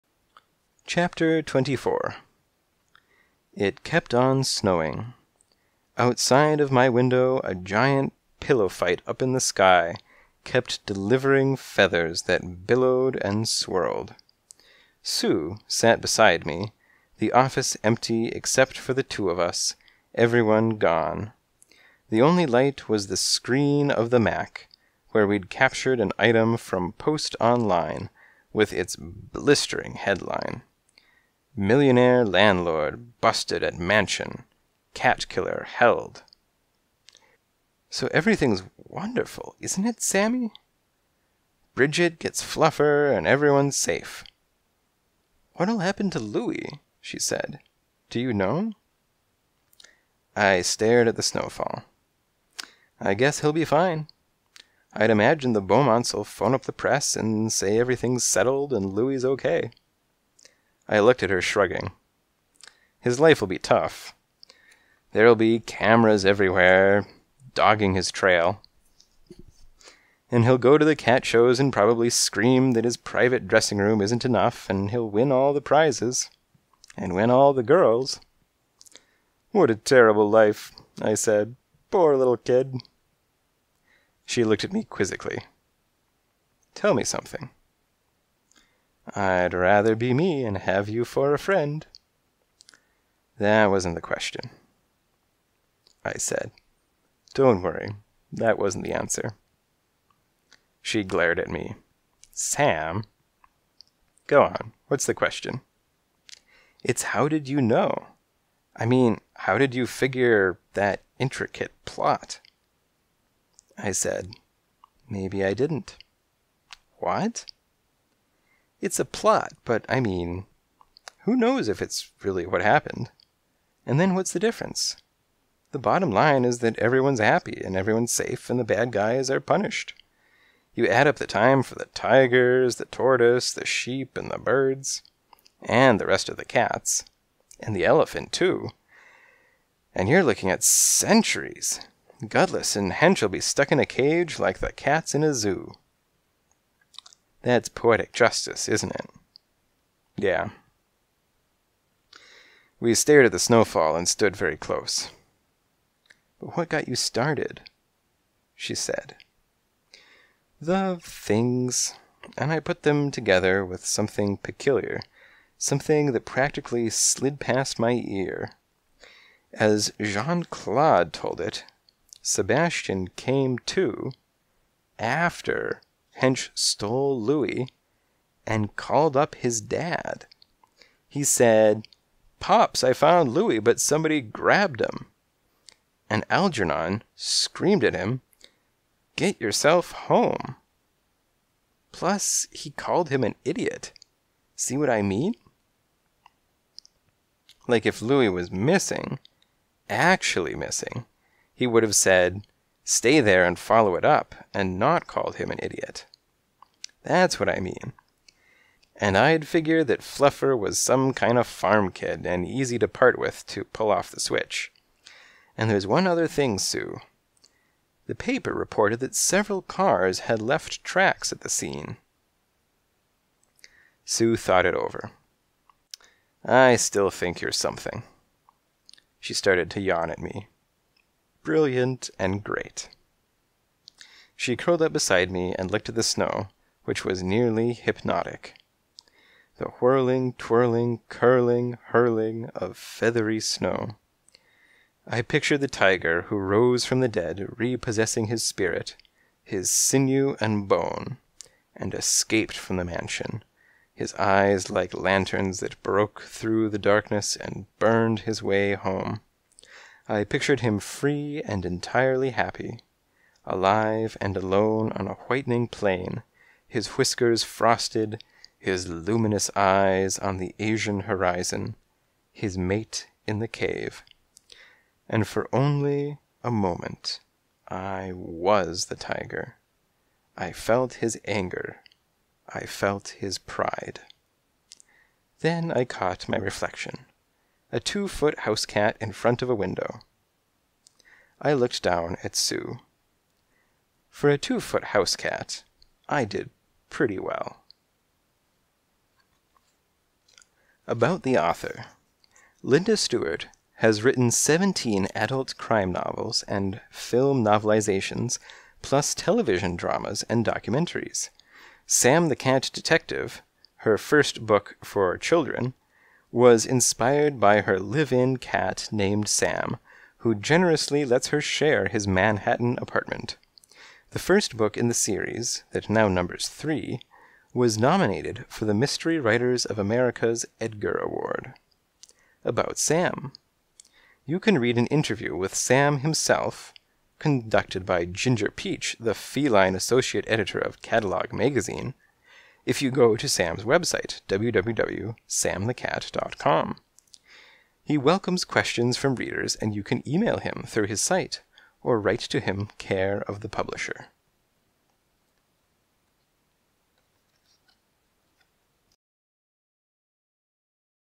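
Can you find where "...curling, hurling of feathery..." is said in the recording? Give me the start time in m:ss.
4:01.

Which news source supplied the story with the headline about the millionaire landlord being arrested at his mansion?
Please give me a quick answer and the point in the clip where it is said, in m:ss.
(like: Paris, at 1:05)
Post Online, at 0:26.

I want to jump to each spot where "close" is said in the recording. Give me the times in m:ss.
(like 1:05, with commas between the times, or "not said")
2:34.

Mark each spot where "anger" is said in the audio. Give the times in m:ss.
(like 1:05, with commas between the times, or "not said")
4:41.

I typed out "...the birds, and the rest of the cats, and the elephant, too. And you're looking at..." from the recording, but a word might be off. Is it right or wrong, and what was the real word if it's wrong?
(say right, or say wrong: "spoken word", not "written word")
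right.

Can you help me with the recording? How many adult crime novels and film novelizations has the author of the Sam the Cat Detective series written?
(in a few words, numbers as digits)
17.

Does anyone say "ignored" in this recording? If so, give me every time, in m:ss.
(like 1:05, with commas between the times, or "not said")
not said.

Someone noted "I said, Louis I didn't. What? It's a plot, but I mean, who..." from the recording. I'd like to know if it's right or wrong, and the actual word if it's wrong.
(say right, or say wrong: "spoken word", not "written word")
wrong: "Maybe", not "Louis".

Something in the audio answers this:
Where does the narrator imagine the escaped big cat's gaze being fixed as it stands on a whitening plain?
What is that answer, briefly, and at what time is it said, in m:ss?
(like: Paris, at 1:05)
the Asian horizon, at 4:30.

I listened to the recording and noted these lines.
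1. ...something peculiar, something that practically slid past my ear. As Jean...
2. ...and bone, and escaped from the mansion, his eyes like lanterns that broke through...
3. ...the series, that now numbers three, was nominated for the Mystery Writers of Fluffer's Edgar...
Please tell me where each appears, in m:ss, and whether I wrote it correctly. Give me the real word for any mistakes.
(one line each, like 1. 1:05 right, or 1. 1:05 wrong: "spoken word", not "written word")
1. 2:43 right
2. 4:10 right
3. 5:24 wrong: "America", not "Fluffer".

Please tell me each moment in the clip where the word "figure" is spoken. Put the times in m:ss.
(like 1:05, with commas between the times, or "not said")
1:49, 3:29.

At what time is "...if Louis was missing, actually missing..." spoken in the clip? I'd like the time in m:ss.
3:17.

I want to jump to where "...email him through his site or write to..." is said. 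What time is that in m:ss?
5:50.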